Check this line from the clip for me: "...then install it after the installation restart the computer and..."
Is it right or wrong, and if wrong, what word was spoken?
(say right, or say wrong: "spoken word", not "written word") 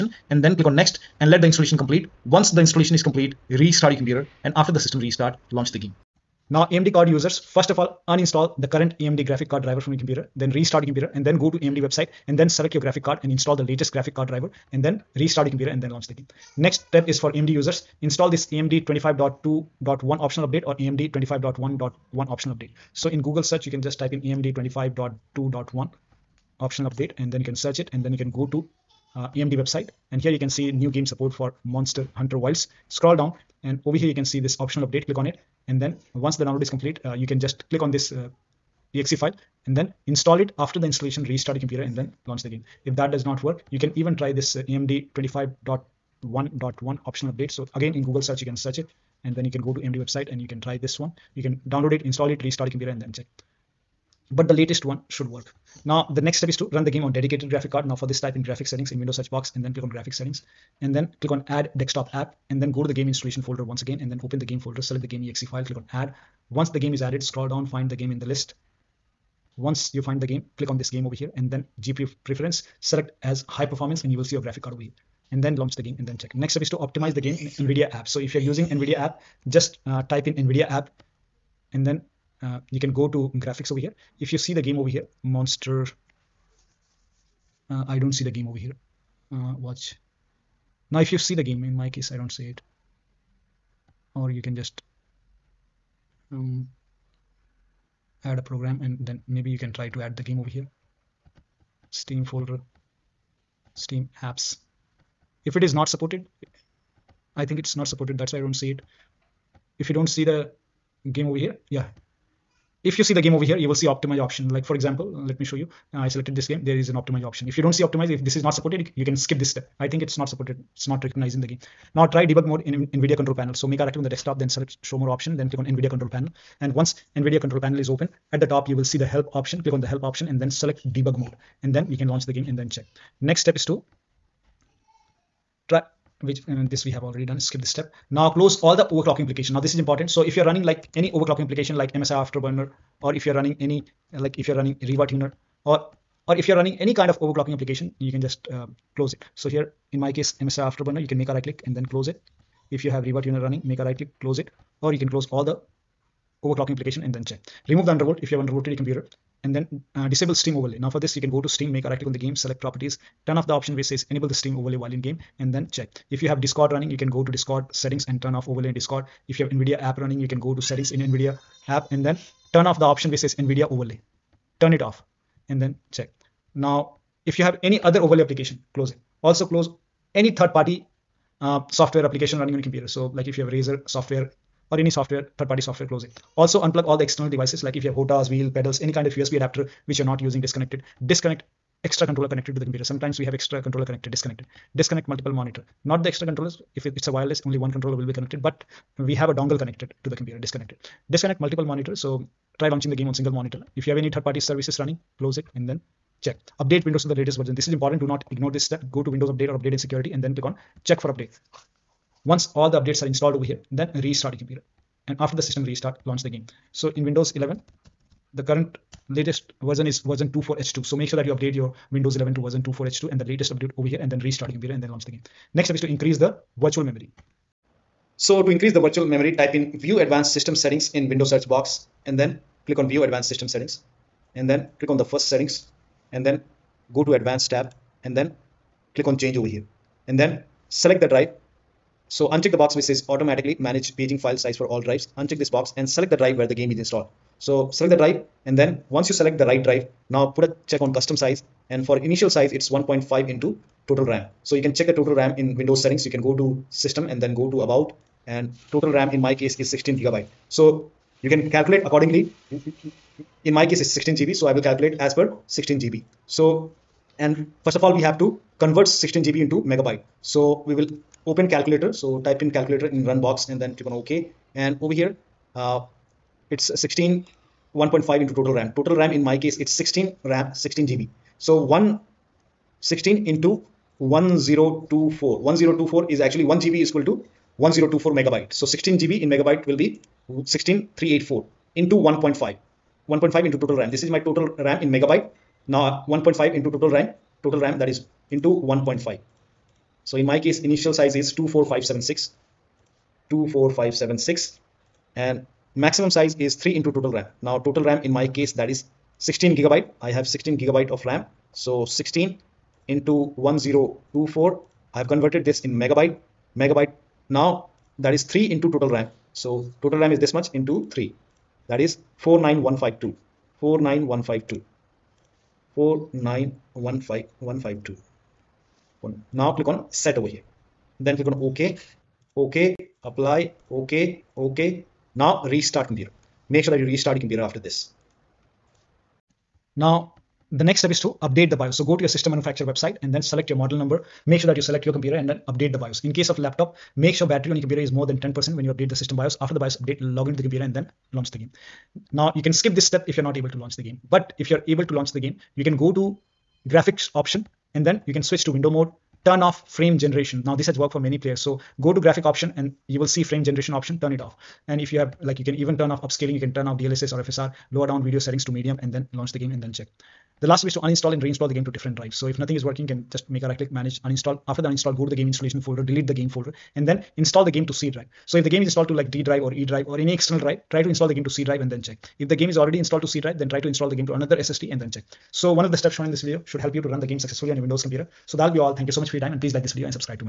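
right.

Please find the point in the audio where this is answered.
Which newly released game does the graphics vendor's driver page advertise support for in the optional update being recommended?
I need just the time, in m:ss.
0:31.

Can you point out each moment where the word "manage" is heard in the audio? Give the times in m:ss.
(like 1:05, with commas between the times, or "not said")
4:03, 6:13.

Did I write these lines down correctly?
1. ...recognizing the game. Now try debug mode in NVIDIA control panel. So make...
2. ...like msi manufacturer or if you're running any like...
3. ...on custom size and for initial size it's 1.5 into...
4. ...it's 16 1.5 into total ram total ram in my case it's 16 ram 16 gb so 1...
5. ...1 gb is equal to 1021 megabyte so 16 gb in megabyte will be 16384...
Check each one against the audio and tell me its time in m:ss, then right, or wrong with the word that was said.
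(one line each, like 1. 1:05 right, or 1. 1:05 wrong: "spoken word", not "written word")
1. 2:01 right
2. 2:21 wrong: "afterburner", not "manufacturer"
3. 4:10 right
4. 4:36 right
5. 4:46 wrong: "1024", not "1021".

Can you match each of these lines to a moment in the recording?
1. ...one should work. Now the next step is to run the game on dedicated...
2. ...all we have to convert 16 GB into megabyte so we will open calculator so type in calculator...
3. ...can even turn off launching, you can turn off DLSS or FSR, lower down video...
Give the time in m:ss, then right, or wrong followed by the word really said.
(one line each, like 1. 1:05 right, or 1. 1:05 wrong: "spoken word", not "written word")
1. 0:54 right
2. 4:27 right
3. 6:05 wrong: "upscaling", not "launching".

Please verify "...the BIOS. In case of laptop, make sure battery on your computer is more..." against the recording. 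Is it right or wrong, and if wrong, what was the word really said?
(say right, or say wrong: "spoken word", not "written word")
right.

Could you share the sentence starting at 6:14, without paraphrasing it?
After the uninstall, go to the game installation folder, delete the game folder, and then install the game to C drive.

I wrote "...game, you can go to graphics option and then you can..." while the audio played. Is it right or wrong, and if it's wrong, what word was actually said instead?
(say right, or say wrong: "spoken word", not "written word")
right.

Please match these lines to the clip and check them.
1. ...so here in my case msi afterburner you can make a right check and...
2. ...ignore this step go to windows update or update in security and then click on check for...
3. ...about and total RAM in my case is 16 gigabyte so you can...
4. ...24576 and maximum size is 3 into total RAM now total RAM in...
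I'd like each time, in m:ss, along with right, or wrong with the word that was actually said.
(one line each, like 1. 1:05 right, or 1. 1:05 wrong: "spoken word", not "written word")
1. 2:29 wrong: "click", not "check"
2. 3:28 right
3. 4:17 right
4. 5:03 right.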